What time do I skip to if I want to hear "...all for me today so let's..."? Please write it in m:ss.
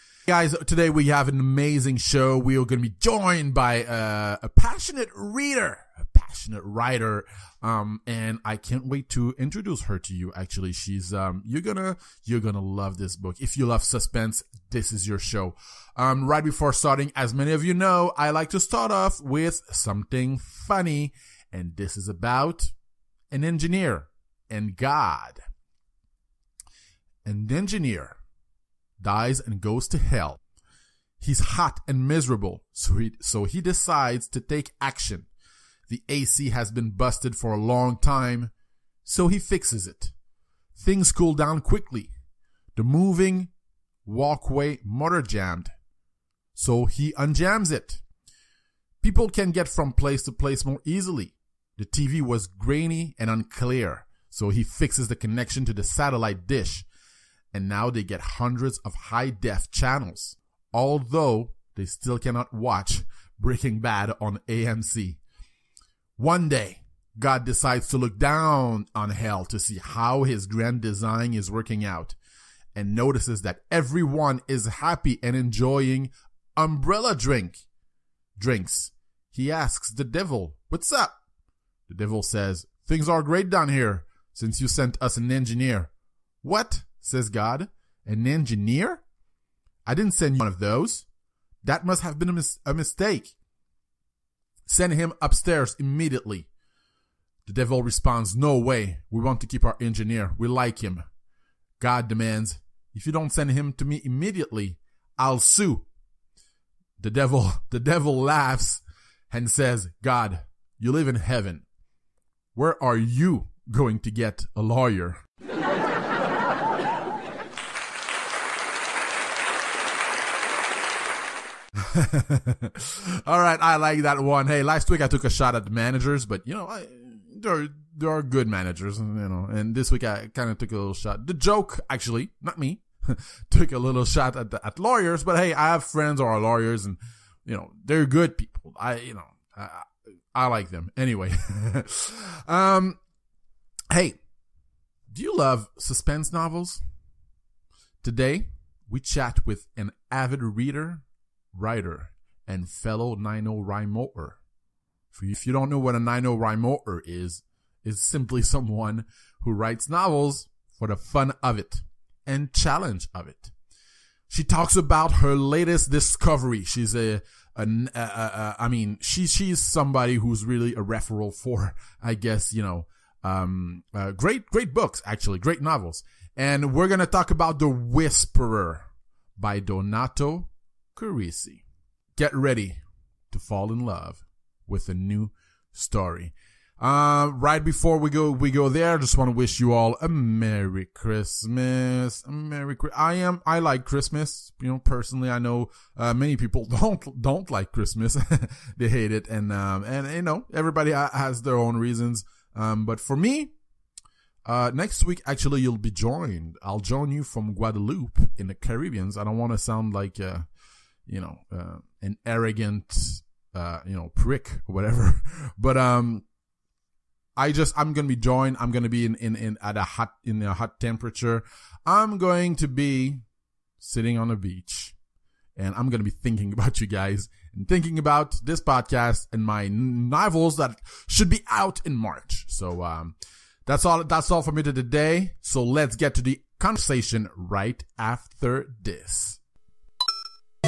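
3:54.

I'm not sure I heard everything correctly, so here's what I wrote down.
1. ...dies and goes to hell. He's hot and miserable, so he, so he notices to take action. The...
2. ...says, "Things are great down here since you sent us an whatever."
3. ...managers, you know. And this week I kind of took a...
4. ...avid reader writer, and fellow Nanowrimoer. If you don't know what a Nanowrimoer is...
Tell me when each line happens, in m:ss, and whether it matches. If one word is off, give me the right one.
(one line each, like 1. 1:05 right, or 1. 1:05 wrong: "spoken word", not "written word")
1. 0:29 wrong: "decides", not "notices"
2. 1:22 wrong: "engineer", not "whatever"
3. 2:08 right
4. 2:30 right.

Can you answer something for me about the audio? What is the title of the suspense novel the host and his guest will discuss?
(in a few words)
The Whisperer.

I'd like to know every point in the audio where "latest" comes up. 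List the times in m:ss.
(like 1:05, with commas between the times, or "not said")
2:45.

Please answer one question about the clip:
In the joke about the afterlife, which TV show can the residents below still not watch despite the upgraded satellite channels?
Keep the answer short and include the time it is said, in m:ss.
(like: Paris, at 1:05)
Breaking Bad, at 1:03.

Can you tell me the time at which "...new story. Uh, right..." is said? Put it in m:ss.
3:04.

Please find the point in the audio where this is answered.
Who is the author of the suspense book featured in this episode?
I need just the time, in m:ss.
2:59.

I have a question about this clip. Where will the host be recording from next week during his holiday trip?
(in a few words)
Guadeloupe.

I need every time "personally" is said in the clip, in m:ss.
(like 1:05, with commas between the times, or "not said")
3:14.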